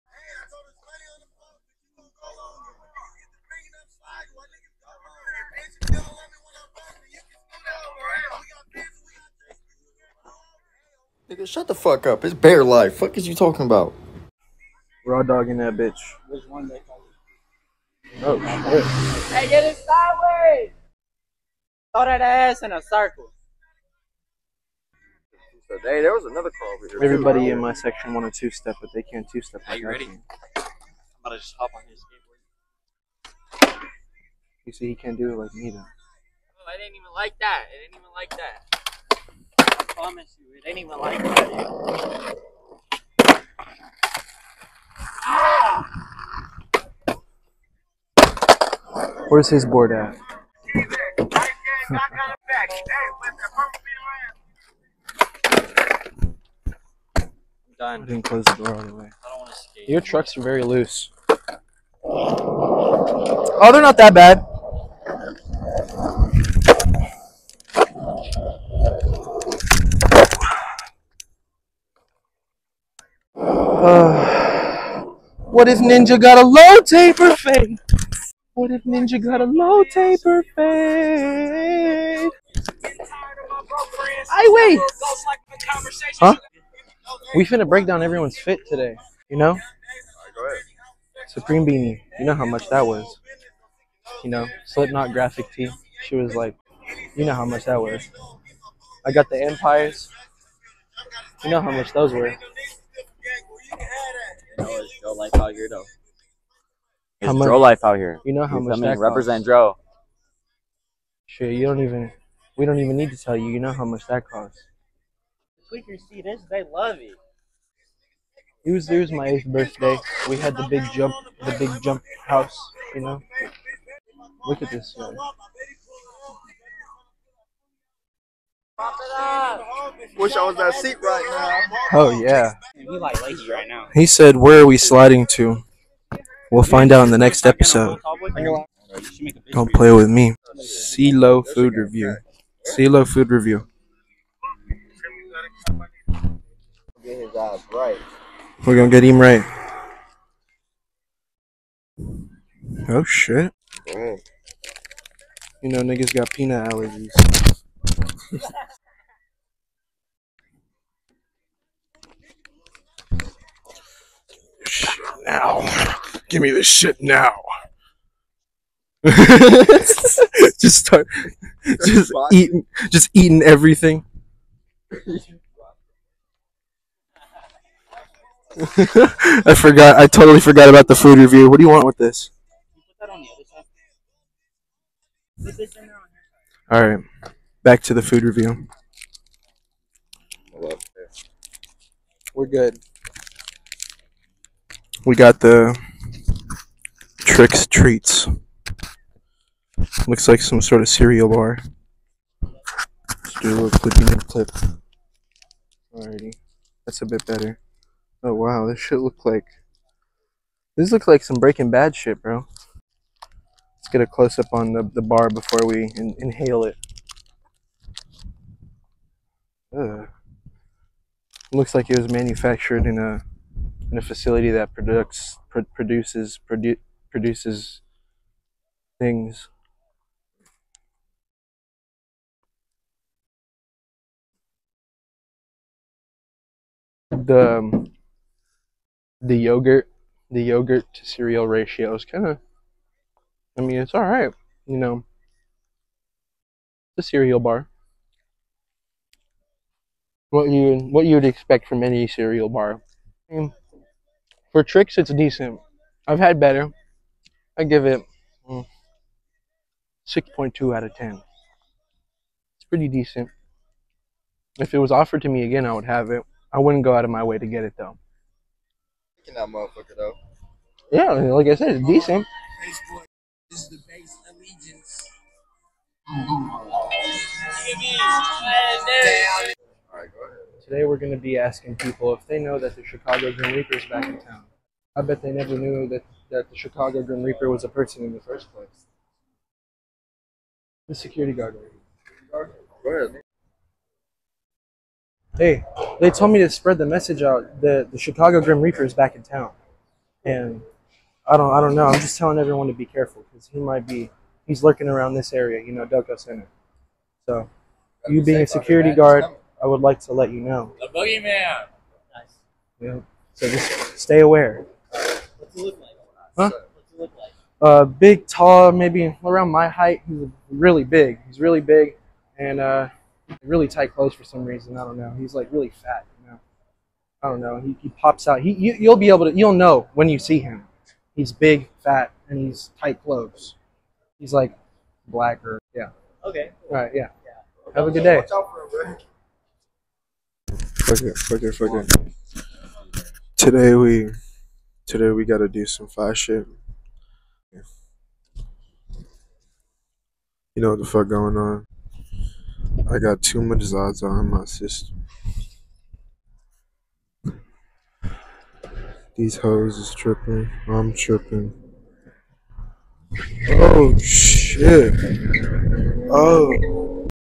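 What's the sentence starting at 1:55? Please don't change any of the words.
Tweakers see this, they love it.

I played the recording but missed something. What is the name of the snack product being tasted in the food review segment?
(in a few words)
Trix Treats.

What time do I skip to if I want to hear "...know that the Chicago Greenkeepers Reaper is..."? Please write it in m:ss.
4:42.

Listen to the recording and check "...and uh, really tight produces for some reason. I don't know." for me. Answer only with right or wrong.
wrong.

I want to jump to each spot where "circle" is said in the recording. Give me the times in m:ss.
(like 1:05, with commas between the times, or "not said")
0:22.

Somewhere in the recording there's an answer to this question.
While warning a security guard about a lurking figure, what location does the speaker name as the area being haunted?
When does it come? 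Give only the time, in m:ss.
5:05.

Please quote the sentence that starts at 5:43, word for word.
Today we Today we gotta do some fire shit.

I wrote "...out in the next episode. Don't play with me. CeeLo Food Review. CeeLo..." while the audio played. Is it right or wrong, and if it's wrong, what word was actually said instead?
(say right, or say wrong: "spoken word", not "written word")
right.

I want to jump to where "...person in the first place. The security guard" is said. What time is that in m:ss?
4:47.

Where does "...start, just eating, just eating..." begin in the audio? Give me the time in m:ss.
2:50.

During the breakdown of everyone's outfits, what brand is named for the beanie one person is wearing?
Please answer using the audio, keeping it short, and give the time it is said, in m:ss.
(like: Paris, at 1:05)
Supreme, at 1:31.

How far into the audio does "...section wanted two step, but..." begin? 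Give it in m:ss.
0:27.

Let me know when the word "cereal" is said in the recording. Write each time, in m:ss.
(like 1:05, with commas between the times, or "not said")
3:20, 4:01, 4:07, 4:12.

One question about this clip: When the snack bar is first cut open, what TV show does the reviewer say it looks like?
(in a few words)
Breaking Bad.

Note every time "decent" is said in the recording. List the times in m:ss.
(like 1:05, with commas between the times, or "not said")
4:15, 4:22, 4:31.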